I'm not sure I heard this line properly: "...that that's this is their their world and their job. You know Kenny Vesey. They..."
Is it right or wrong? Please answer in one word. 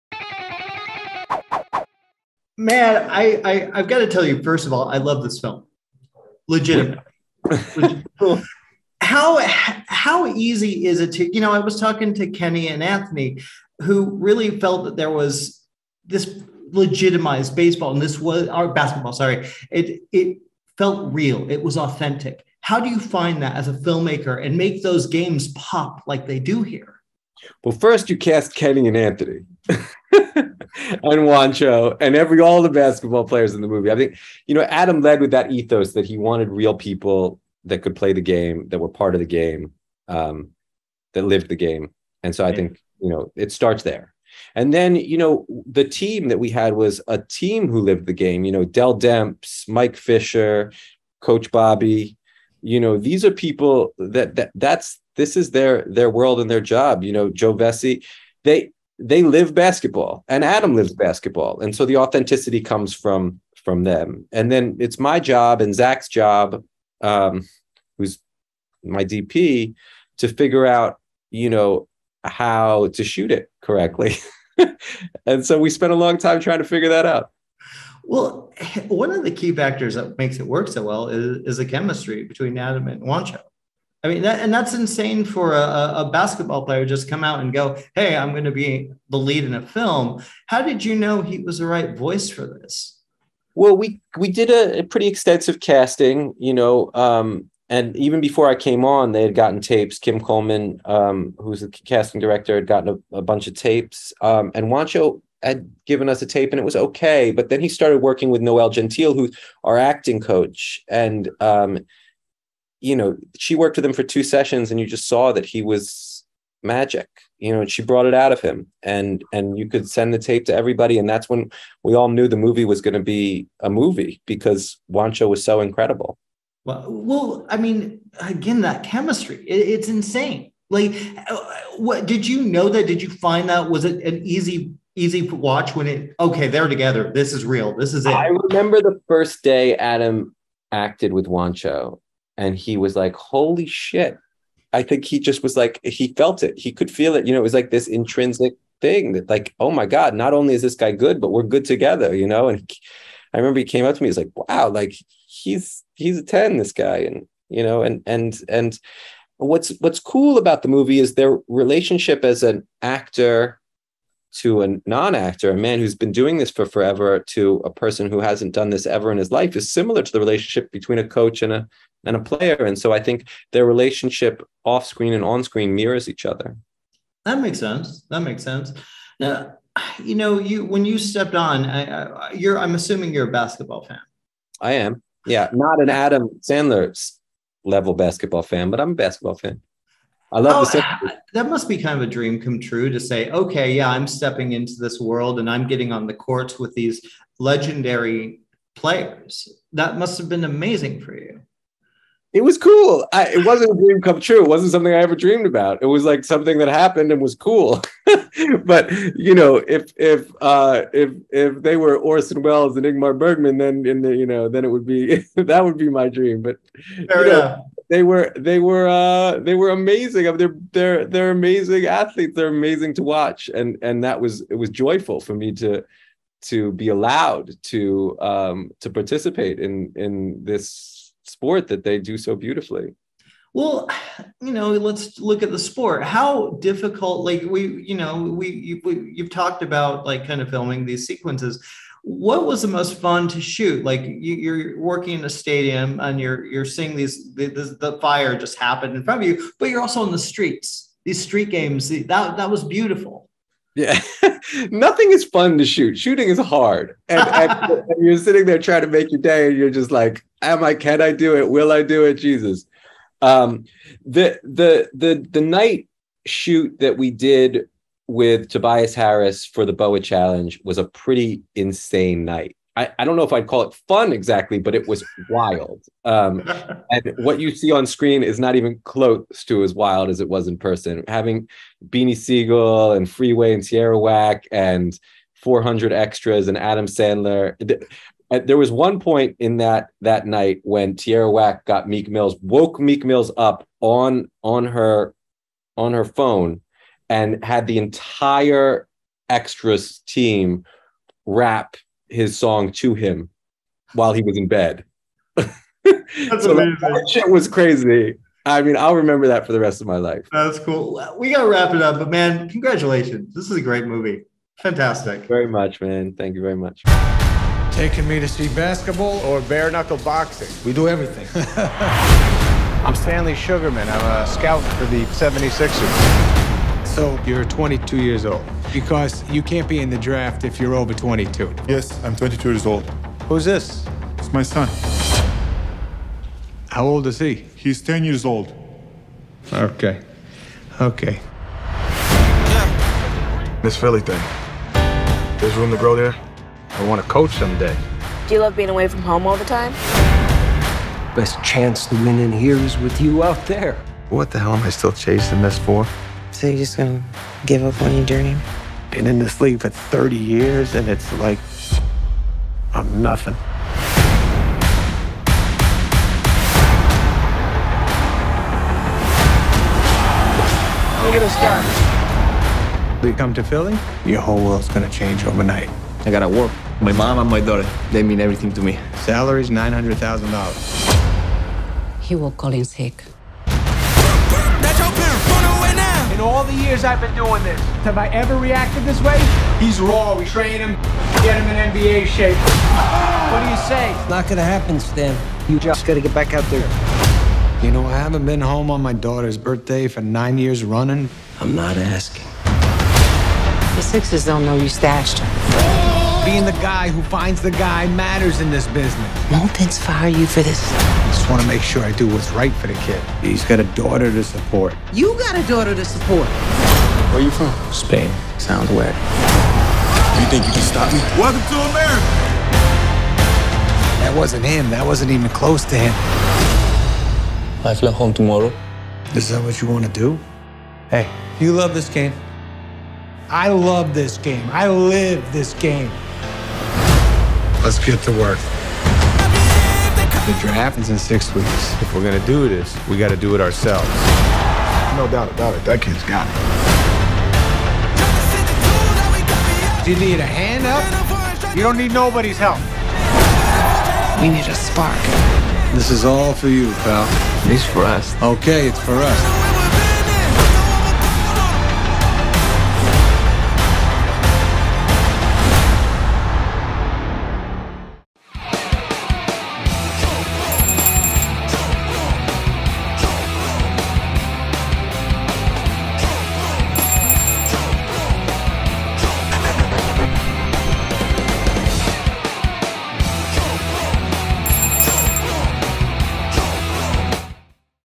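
wrong.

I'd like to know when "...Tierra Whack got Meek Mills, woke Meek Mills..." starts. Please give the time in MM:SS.
04:50.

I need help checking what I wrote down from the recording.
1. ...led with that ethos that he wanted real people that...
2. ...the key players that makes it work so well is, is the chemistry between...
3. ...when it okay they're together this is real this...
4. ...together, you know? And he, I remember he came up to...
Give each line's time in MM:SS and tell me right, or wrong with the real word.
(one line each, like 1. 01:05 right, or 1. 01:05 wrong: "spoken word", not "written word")
1. 00:35 right
2. 01:19 wrong: "factors", not "players"
3. 02:15 right
4. 02:31 right.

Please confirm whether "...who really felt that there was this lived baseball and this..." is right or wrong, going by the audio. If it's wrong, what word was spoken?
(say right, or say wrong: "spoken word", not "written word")
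wrong: "legitimized", not "lived".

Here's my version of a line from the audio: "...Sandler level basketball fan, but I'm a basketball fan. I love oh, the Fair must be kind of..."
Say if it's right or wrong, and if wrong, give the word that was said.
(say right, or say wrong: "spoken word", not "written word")
wrong: "That", not "Fair".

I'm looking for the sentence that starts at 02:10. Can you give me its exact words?
Like, uh, what did you know that?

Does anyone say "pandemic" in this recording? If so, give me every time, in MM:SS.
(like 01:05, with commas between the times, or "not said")
not said.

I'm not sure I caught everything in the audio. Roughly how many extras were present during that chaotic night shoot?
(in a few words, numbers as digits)
400.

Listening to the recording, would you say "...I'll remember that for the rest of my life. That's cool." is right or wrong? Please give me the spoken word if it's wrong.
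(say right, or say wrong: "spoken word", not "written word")
right.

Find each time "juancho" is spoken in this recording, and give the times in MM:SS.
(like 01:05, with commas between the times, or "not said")
00:31, 01:23, 01:44, 02:04, 02:21.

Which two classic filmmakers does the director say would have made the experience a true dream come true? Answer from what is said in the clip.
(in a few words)
Orson Welles and Ingmar Bergman.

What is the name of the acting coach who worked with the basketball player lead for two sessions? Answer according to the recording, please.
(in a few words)
Noel Gentile.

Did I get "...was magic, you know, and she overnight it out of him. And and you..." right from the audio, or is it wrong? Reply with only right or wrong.
wrong.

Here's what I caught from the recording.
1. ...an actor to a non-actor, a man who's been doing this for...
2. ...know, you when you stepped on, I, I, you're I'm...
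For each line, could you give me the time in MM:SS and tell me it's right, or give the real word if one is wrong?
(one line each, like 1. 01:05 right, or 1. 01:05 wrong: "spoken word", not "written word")
1. 02:42 right
2. 03:00 right.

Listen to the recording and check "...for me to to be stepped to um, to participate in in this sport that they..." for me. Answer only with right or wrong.
wrong.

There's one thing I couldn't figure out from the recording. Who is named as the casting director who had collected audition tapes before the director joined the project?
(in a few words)
Kim Coleman.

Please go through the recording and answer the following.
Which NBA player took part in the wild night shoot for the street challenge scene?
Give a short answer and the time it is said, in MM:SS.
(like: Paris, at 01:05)
Tobias Harris, at 04:28.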